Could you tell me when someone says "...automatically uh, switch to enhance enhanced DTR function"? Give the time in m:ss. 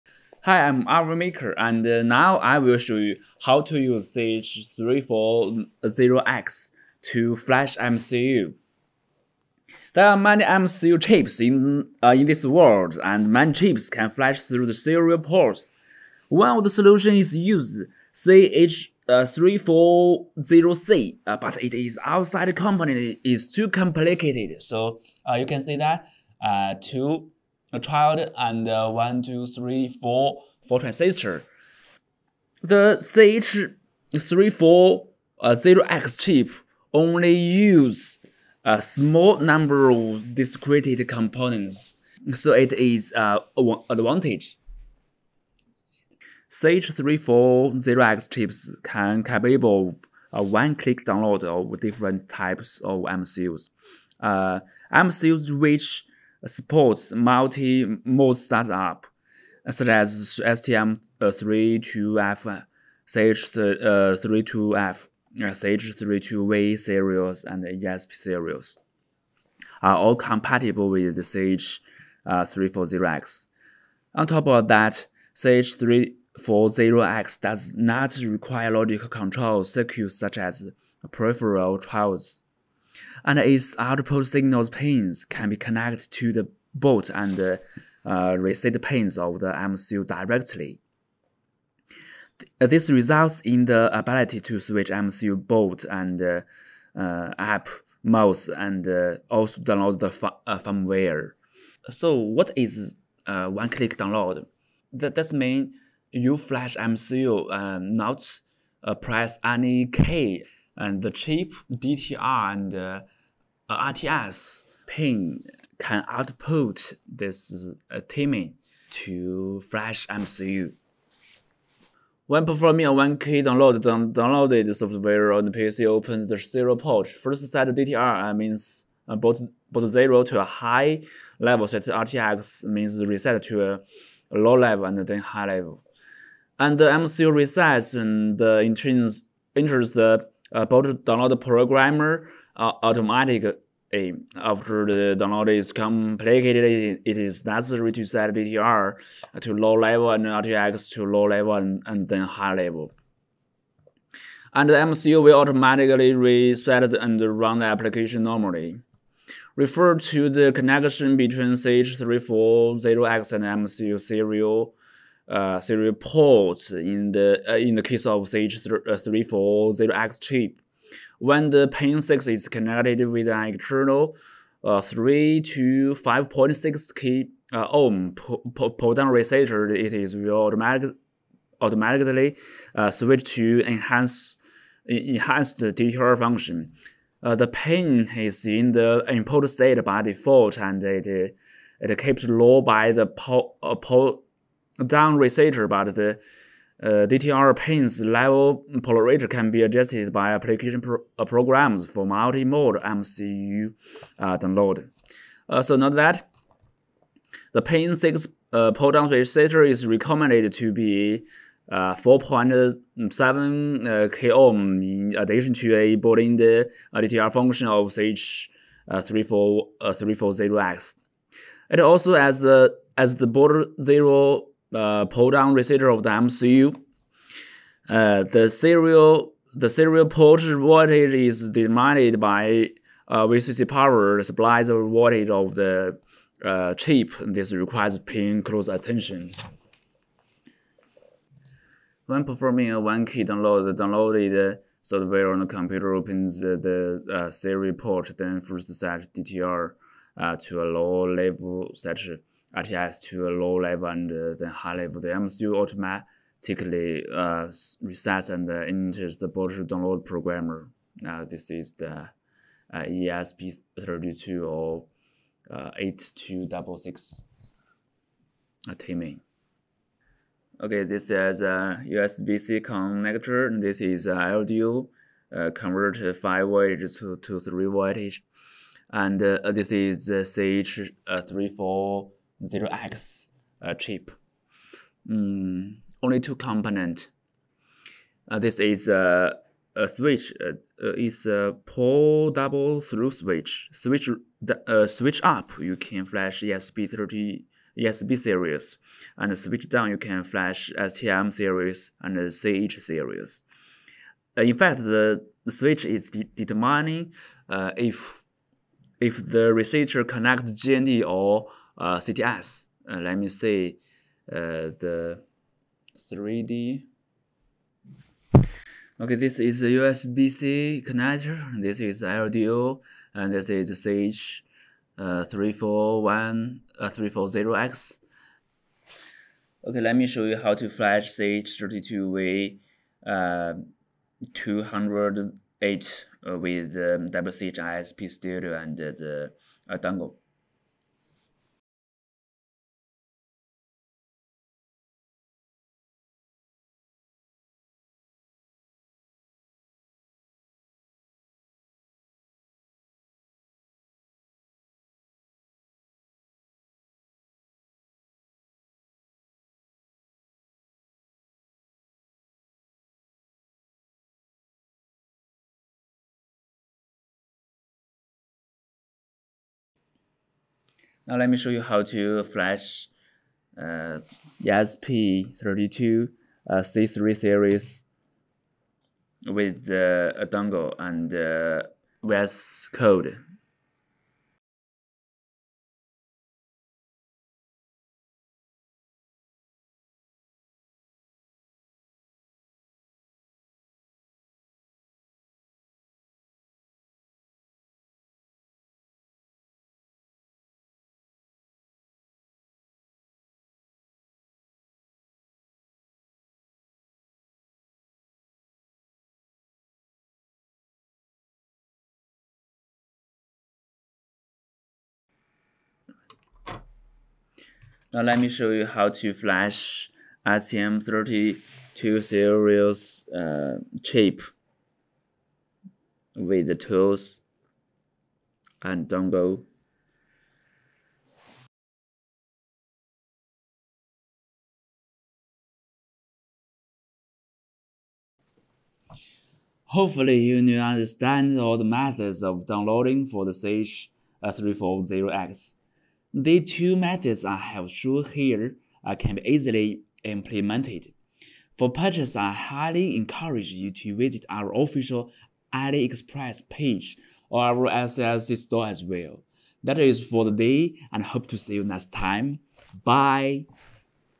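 3:01.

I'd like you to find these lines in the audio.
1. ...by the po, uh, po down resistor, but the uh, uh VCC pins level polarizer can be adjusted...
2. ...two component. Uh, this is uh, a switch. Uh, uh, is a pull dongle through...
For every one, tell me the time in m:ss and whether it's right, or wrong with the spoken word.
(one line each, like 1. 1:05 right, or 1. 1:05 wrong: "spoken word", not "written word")
1. 3:12 wrong: "DTR", not "VCC"
2. 4:46 wrong: "double", not "dongle".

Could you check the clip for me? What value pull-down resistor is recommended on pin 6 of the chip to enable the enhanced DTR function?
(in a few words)
4.7k ohm.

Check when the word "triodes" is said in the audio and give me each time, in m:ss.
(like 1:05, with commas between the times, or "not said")
1:21.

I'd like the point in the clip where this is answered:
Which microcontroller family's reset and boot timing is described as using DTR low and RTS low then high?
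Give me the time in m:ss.
4:22.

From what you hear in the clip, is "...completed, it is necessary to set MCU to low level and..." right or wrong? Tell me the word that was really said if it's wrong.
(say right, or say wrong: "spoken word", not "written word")
wrong: "DTR", not "MCU".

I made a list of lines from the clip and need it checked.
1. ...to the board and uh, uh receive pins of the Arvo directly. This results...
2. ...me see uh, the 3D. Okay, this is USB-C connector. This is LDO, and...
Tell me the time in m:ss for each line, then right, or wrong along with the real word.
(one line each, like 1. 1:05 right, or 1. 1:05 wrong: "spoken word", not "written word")
1. 1:26 wrong: "MCU", not "Arvo"
2. 5:13 right.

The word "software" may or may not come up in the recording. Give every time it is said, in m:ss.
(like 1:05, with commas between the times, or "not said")
2:04, 4:04.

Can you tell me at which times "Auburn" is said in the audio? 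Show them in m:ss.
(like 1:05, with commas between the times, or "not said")
not said.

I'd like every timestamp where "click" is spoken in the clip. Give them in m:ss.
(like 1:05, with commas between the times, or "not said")
0:50, 1:43.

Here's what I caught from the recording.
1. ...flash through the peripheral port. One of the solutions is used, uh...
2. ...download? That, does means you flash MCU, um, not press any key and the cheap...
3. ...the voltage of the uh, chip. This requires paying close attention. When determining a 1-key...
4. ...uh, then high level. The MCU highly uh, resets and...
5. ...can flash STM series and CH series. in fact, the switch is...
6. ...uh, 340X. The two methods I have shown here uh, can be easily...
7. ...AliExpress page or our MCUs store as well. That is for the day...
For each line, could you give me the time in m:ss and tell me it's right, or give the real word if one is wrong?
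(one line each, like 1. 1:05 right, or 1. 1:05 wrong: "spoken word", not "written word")
1. 0:14 wrong: "serial", not "peripheral"
2. 1:43 right
3. 3:54 wrong: "performing", not "determining"
4. 4:14 wrong: "automatically", not "highly"
5. 4:59 right
6. 7:24 right
7. 7:35 wrong: "SLC", not "MCUs".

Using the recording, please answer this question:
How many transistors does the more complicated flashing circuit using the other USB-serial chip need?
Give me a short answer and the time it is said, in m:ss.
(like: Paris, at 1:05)
4, at 0:30.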